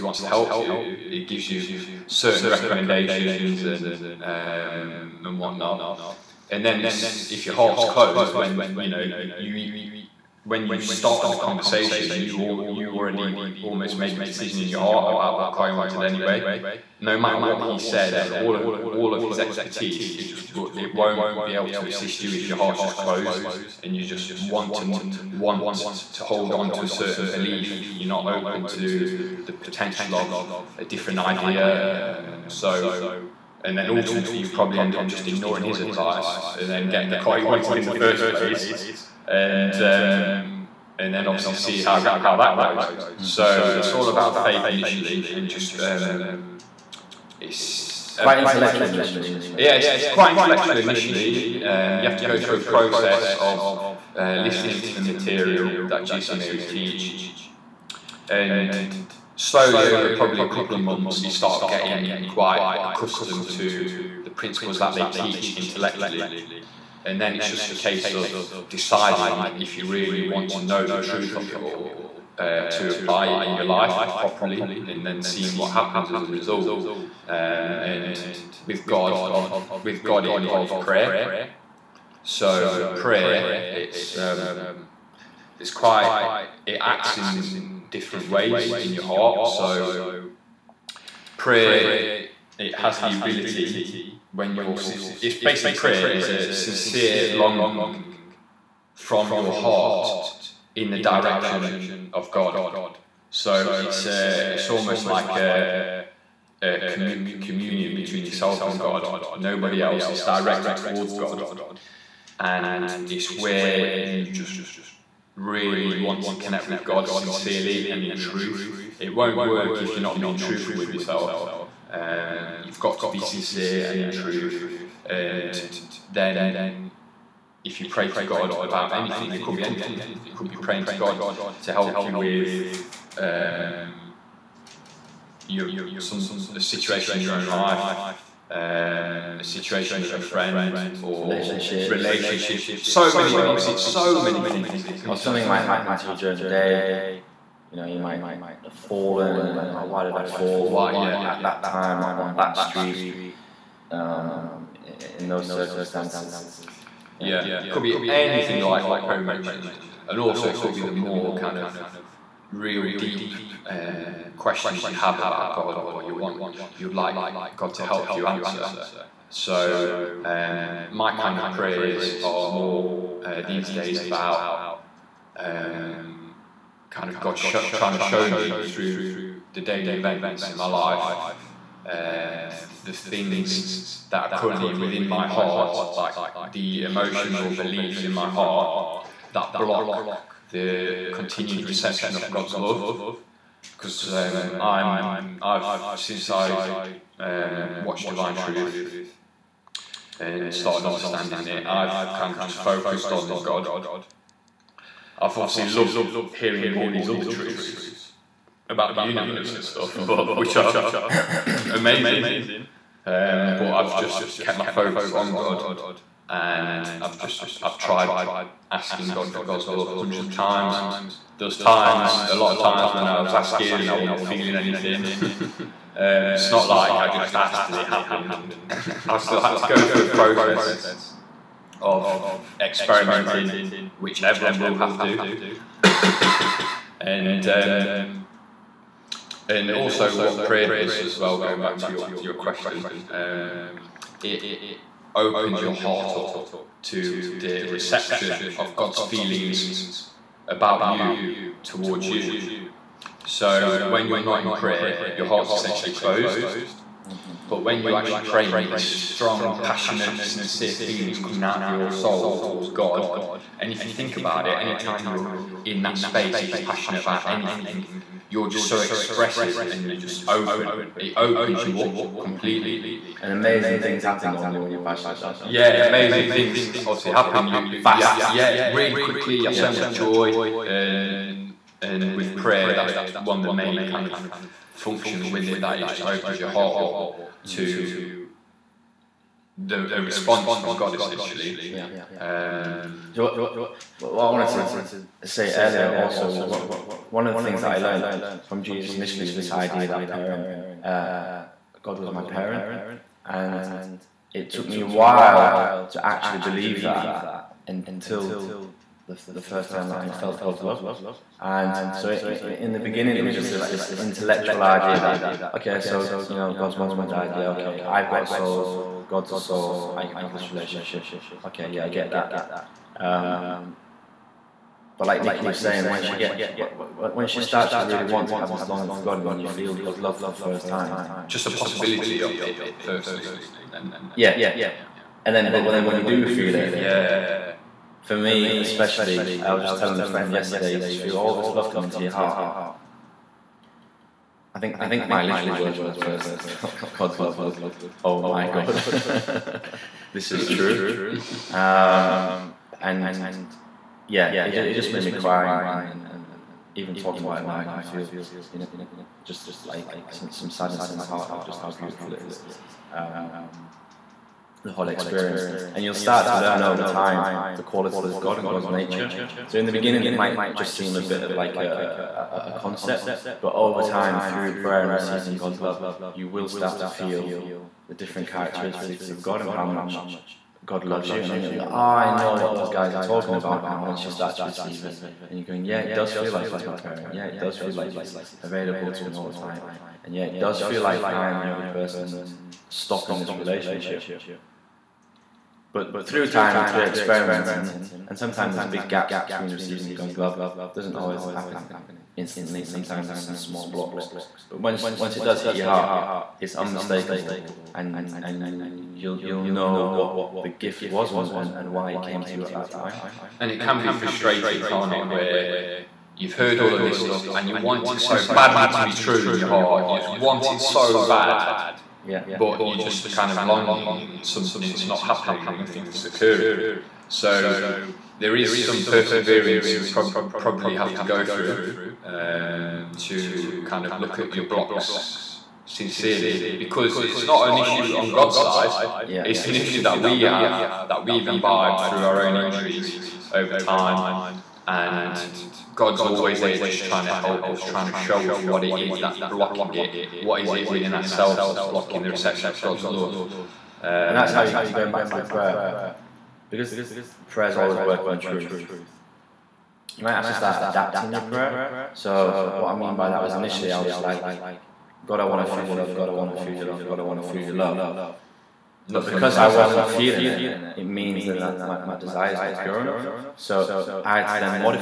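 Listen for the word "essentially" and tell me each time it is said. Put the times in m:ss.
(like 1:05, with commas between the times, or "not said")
4:15, 4:50.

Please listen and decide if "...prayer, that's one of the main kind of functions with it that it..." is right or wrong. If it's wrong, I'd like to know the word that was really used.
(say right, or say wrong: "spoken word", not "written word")
right.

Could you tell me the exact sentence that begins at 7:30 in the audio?
What is it within ourselves that's blocking the reception of God's mm-hmm.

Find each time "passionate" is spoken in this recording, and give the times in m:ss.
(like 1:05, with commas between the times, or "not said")
4:19, 4:26, 4:34.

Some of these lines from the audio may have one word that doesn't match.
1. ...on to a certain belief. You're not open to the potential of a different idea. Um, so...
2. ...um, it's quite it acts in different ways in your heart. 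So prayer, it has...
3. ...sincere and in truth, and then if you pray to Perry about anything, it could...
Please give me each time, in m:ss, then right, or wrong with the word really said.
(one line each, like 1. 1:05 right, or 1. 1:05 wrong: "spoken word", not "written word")
1. 0:26 right
2. 1:24 right
3. 2:03 wrong: "God", not "Perry".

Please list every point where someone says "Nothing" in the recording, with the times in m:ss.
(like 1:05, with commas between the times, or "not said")
7:05.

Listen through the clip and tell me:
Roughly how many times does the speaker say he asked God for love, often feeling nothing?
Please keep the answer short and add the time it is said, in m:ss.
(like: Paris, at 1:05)
hundreds of times, at 3:39.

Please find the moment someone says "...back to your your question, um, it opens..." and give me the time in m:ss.
4:01.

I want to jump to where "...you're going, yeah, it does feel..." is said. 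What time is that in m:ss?
6:25.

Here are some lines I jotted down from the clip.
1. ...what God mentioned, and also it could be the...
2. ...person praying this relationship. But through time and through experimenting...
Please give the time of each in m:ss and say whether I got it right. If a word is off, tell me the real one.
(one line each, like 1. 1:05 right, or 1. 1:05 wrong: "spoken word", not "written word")
1. 2:38 wrong: "Perry", not "God"
2. 6:31 wrong: "stopping", not "praying".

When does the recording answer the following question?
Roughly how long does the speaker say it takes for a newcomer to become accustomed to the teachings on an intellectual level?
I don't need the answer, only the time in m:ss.
1:00.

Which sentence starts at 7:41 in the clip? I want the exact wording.
So what I mean by that was initially I was like, God, I want to feel your love.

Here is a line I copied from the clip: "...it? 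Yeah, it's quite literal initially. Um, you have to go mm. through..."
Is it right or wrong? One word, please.
wrong.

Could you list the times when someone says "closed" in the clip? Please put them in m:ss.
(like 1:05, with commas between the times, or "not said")
0:07, 0:22, 4:15.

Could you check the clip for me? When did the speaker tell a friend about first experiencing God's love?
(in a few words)
yesterday.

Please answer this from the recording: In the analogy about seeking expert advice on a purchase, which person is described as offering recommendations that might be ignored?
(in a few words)
Kai.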